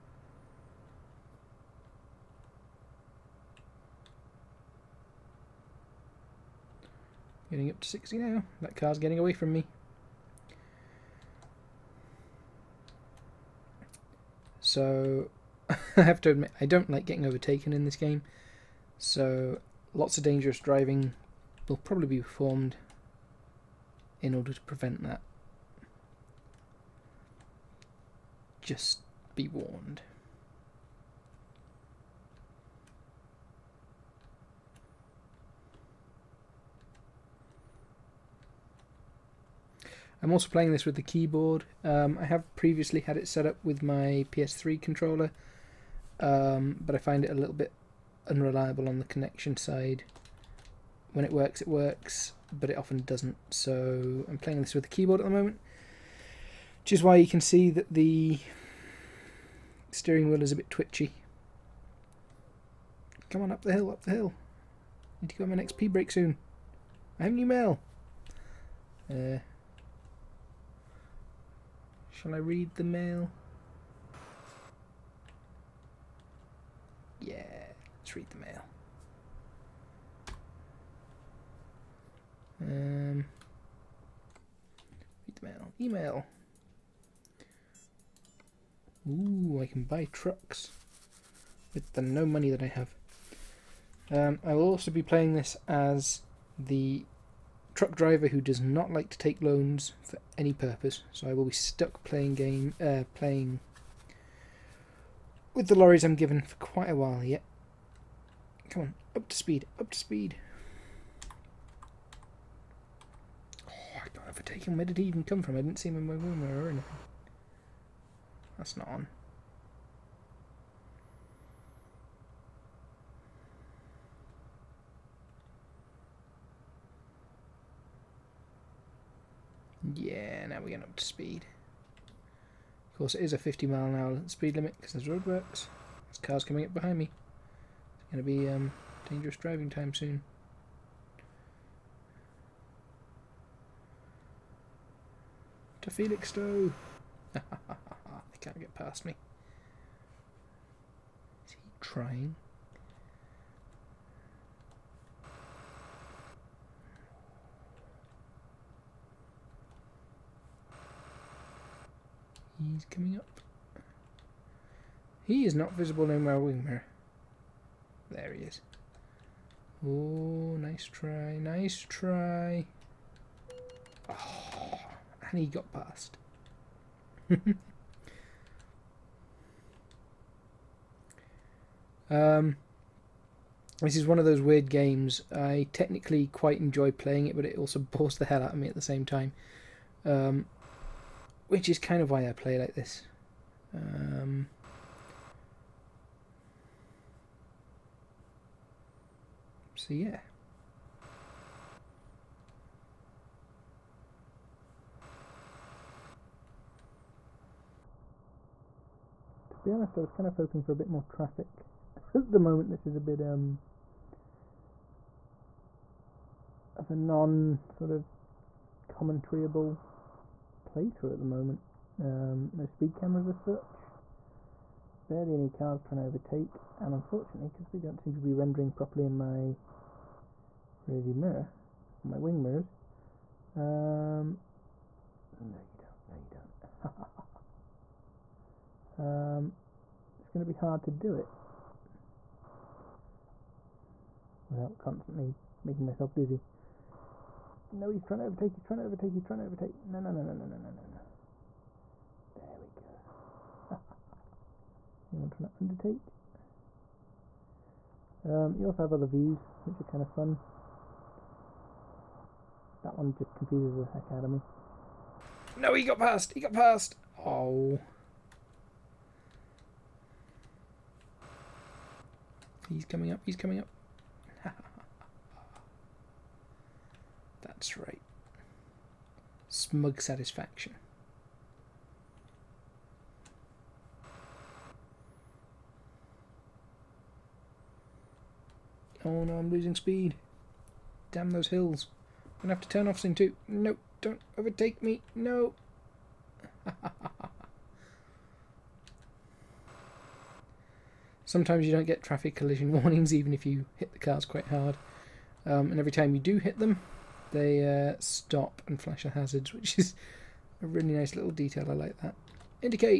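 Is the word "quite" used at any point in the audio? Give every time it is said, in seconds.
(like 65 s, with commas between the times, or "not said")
106 s, 186 s, 304 s.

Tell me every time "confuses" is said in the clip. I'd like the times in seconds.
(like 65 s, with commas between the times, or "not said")
263 s.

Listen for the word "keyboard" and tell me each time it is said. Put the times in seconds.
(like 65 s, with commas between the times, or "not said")
41 s, 54 s.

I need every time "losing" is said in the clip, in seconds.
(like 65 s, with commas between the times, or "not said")
289 s.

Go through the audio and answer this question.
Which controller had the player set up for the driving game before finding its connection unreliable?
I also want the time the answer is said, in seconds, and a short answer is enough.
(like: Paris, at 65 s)
PS3 controller, at 44 s.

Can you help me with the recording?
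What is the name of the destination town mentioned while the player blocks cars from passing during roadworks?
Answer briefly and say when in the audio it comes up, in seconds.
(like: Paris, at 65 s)
Felixstowe, at 146 s.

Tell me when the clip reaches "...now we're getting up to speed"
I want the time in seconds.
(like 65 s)
130 s.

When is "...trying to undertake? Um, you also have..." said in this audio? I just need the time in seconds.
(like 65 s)
255 s.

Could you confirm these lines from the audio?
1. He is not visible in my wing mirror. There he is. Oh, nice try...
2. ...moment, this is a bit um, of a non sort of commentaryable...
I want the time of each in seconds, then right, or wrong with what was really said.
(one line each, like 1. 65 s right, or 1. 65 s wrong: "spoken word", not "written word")
1. 165 s right
2. 212 s right.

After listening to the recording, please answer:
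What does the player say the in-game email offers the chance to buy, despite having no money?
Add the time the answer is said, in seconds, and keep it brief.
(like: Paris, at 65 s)
trucks, at 90 s.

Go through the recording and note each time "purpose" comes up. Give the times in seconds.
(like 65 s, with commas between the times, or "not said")
100 s.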